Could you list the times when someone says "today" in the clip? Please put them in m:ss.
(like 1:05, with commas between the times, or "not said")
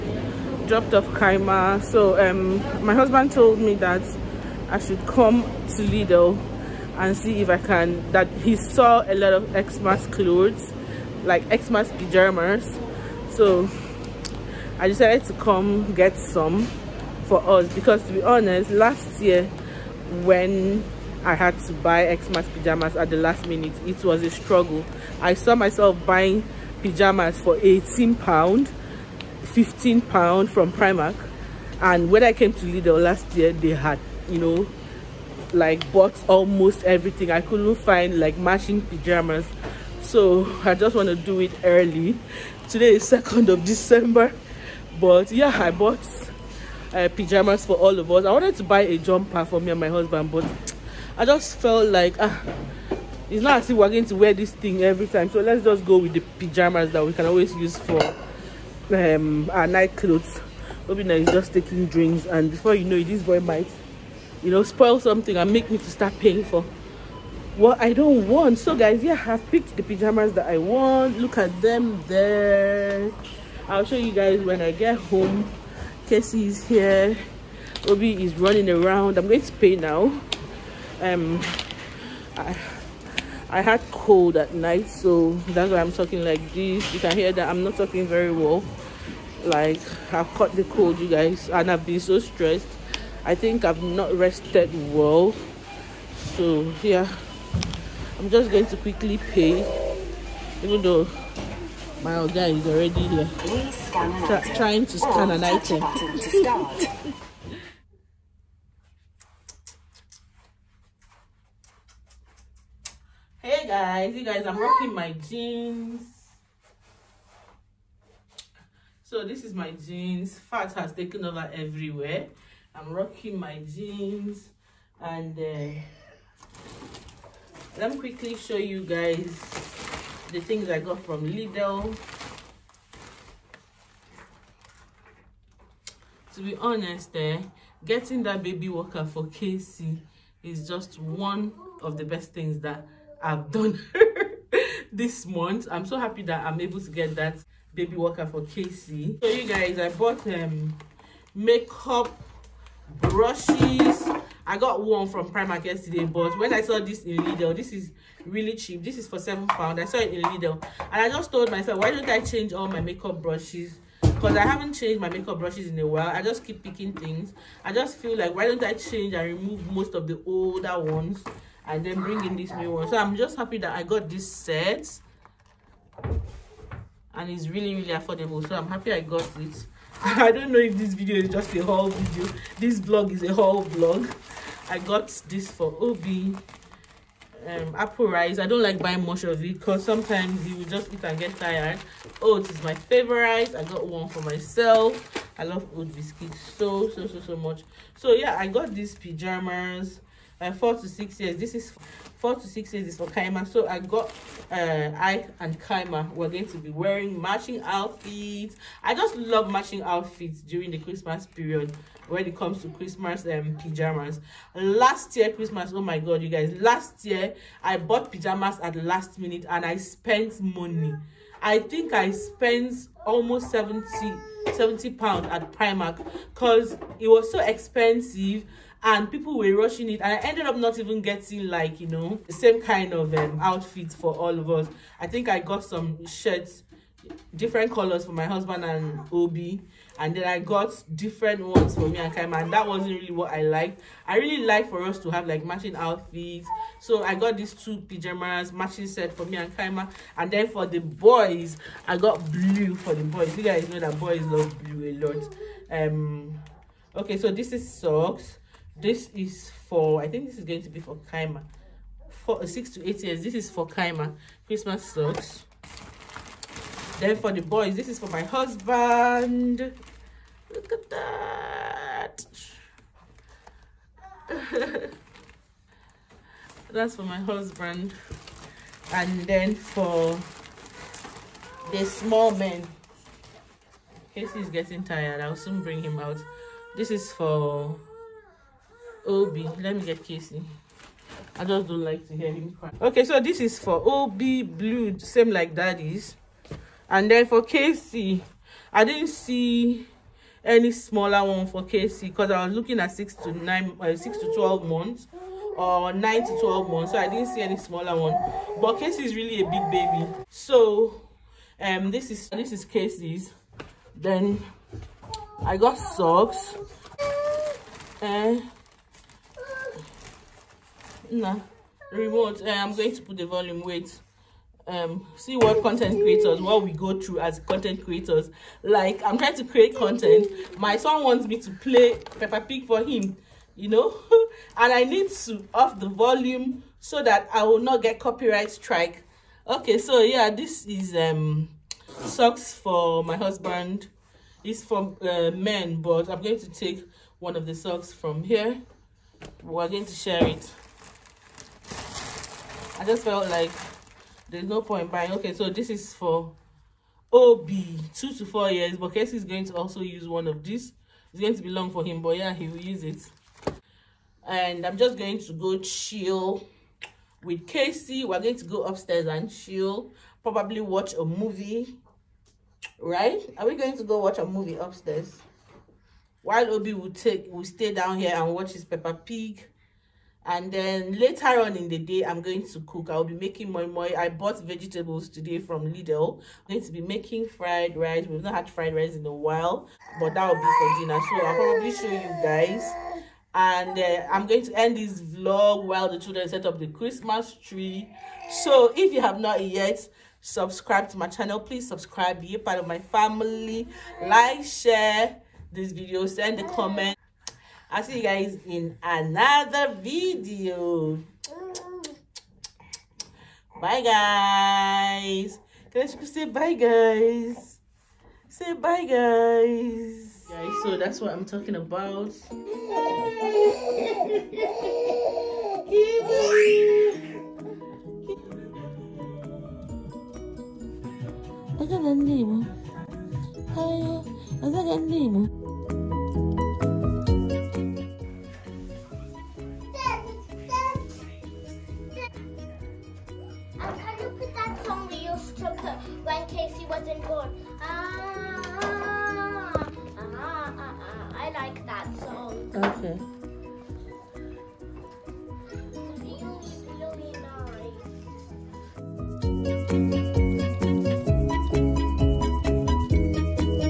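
0:42, 6:25.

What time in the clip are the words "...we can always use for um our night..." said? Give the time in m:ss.
0:57.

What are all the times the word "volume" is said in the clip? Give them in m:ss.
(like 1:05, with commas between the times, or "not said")
5:23, 5:35.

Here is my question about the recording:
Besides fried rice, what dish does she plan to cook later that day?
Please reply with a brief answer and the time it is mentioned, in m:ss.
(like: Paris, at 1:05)
Moi moi, at 6:23.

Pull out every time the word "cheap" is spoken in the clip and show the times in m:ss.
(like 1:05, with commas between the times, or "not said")
2:38.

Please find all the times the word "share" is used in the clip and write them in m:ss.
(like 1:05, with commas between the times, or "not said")
5:49, 6:44.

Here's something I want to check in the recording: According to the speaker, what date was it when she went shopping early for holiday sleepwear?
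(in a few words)
2nd of December.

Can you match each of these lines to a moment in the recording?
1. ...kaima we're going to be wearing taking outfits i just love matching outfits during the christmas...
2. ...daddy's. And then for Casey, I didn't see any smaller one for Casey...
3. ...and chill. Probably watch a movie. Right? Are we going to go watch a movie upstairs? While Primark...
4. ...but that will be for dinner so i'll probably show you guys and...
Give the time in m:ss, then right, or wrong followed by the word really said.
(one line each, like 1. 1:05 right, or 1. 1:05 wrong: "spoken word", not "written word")
1. 3:25 wrong: "matching", not "taking"
2. 4:55 right
3. 6:09 wrong: "Obi", not "Primark"
4. 6:29 right.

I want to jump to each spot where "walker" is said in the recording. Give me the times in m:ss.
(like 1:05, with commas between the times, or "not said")
2:18, 2:27.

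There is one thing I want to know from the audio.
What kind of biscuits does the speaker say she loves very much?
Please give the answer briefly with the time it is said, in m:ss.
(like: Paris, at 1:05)
Oat biscuits, at 3:15.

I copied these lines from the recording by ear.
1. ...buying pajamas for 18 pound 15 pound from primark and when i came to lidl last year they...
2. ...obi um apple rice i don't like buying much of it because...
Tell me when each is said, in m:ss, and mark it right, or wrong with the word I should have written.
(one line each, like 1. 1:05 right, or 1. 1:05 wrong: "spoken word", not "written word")
1. 0:26 right
2. 3:05 right.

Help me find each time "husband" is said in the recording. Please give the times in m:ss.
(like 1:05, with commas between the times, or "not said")
0:02, 0:49, 3:58, 4:28, 4:37, 5:43.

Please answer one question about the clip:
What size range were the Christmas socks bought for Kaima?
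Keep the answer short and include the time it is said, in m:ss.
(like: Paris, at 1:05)
6 to 8 years, at 4:22.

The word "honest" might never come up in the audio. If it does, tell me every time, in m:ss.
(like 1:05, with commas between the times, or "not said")
0:18, 2:16.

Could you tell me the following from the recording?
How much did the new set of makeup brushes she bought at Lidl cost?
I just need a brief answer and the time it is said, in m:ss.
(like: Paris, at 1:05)
7 pounds, at 2:39.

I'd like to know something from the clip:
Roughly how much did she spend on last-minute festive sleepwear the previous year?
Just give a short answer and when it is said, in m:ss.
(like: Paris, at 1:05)
70 pounds, at 3:44.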